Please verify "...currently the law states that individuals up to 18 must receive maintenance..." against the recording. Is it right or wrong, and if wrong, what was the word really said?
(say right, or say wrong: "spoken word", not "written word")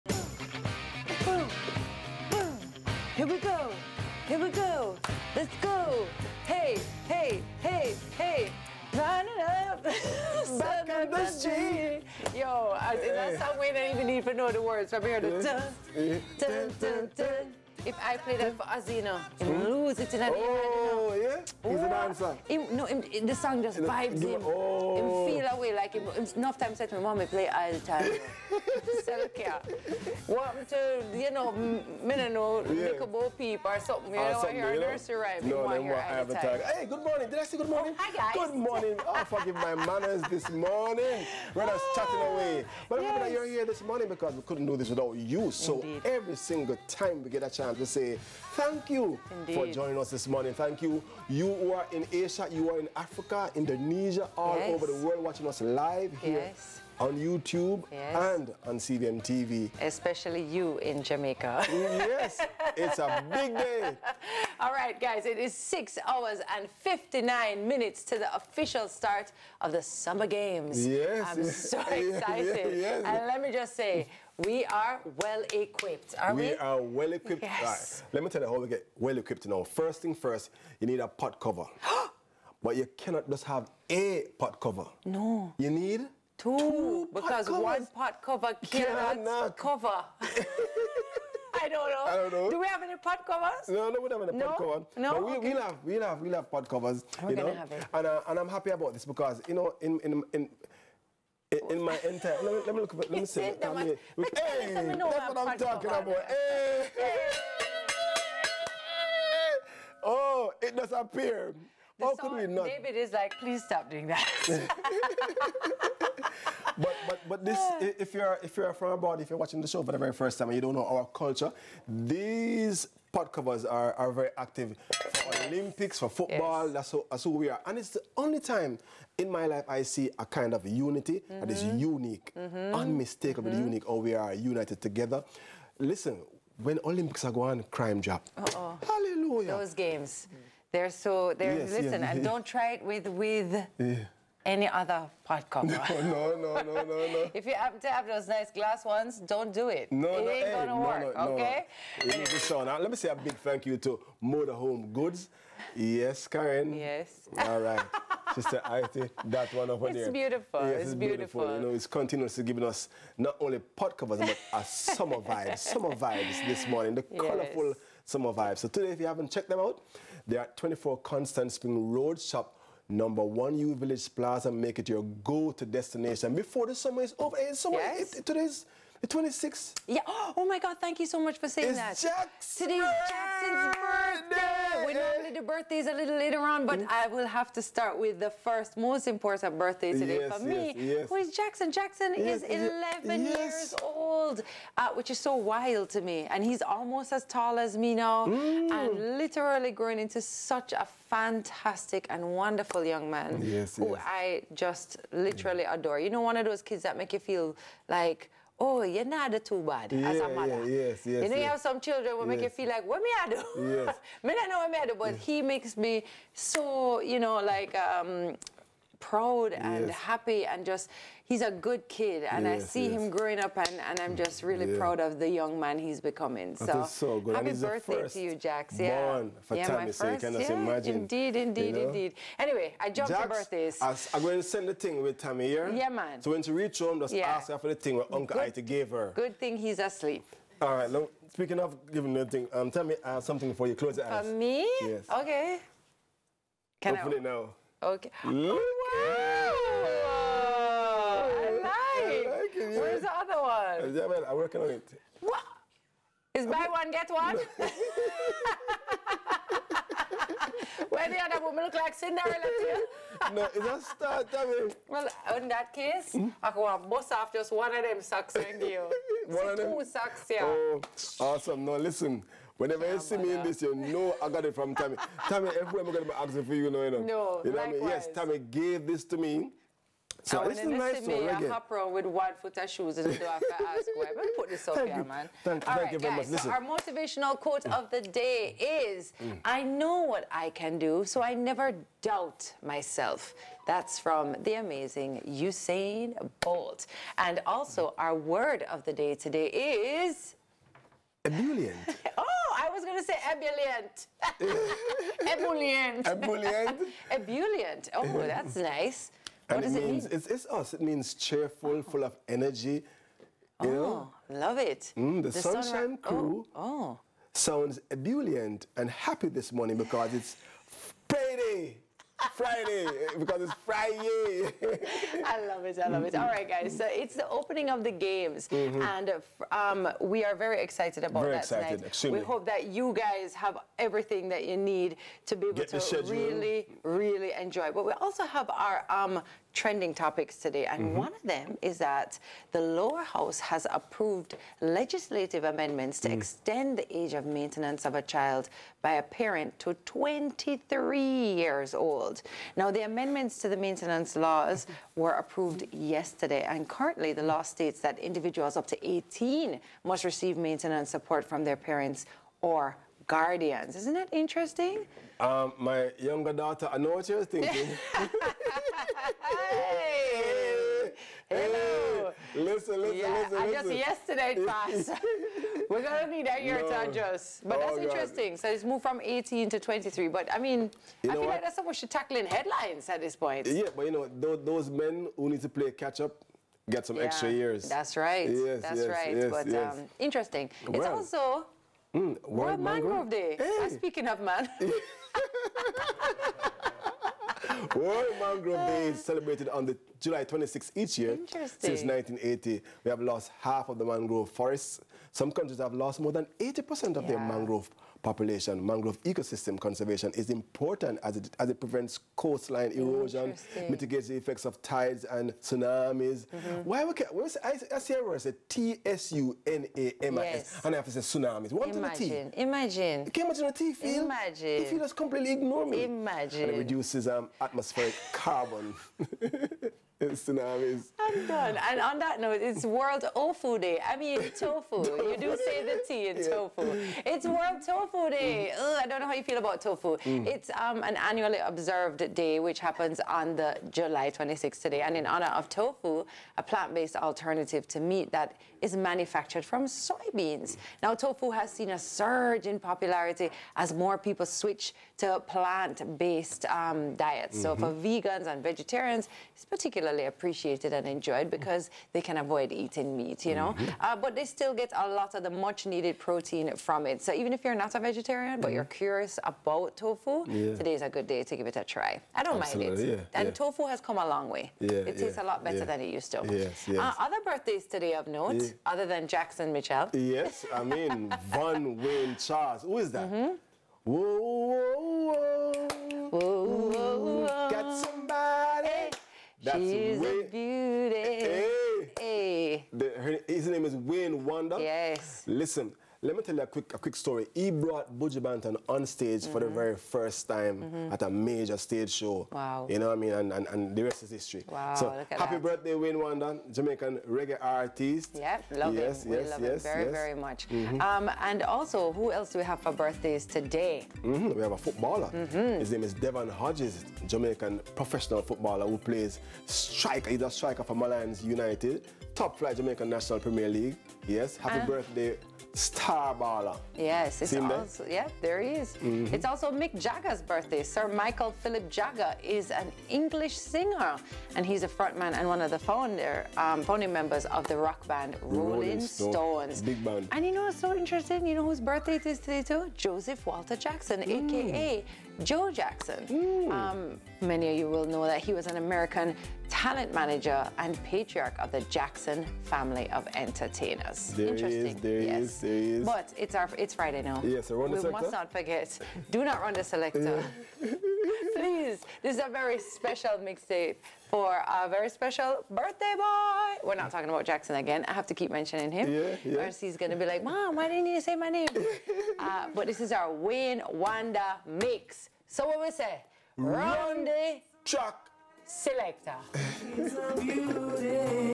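right.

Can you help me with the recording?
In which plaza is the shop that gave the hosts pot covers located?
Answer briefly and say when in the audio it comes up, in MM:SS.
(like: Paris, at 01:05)
U Village Plaza, at 02:53.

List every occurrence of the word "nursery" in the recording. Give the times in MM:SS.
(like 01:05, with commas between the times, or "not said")
00:34.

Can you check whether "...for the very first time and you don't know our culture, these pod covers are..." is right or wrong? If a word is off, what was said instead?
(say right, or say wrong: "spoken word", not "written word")
right.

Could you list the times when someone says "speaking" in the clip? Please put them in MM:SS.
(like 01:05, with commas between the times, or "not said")
04:01, 06:33.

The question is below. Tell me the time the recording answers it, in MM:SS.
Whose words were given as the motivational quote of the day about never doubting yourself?
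04:55.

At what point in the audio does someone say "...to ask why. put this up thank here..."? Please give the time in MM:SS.
04:43.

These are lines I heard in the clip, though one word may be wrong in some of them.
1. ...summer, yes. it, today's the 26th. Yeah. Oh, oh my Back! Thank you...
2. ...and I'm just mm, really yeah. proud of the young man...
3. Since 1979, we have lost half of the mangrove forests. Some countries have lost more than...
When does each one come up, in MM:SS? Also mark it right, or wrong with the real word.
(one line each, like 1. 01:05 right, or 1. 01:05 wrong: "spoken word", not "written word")
1. 02:57 wrong: "God", not "Back"
2. 03:43 right
3. 06:41 wrong: "1980", not "1979".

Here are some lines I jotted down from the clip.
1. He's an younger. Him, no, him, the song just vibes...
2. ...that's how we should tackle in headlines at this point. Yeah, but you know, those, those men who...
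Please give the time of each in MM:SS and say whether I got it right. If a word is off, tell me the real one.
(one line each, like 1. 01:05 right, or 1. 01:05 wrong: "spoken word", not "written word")
1. 00:21 wrong: "answer", not "younger"
2. 06:21 right.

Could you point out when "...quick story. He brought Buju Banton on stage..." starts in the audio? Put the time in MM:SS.
08:16.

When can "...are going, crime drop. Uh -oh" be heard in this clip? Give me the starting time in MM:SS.
02:17.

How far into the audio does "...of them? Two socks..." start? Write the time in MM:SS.
04:29.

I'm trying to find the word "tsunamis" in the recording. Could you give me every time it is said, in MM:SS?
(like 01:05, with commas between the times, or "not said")
06:55, 07:01, 07:10.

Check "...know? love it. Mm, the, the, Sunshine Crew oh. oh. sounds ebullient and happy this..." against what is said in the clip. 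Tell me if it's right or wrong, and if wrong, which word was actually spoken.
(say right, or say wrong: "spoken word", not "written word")
right.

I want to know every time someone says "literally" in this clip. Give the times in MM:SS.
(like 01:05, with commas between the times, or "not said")
03:19, 03:25.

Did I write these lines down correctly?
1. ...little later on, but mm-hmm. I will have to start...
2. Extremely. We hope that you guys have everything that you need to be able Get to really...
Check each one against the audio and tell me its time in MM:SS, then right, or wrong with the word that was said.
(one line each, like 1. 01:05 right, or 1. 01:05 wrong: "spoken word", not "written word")
1. 03:05 right
2. 05:31 right.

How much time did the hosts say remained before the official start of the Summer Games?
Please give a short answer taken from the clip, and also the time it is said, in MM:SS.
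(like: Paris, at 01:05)
6 hours and 59 minutes, at 01:05.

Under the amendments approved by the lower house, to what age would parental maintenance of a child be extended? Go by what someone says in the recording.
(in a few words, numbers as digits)
23.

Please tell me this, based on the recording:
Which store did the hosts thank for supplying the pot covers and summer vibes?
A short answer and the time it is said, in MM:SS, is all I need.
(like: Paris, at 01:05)
Motorhome Goods, at 02:34.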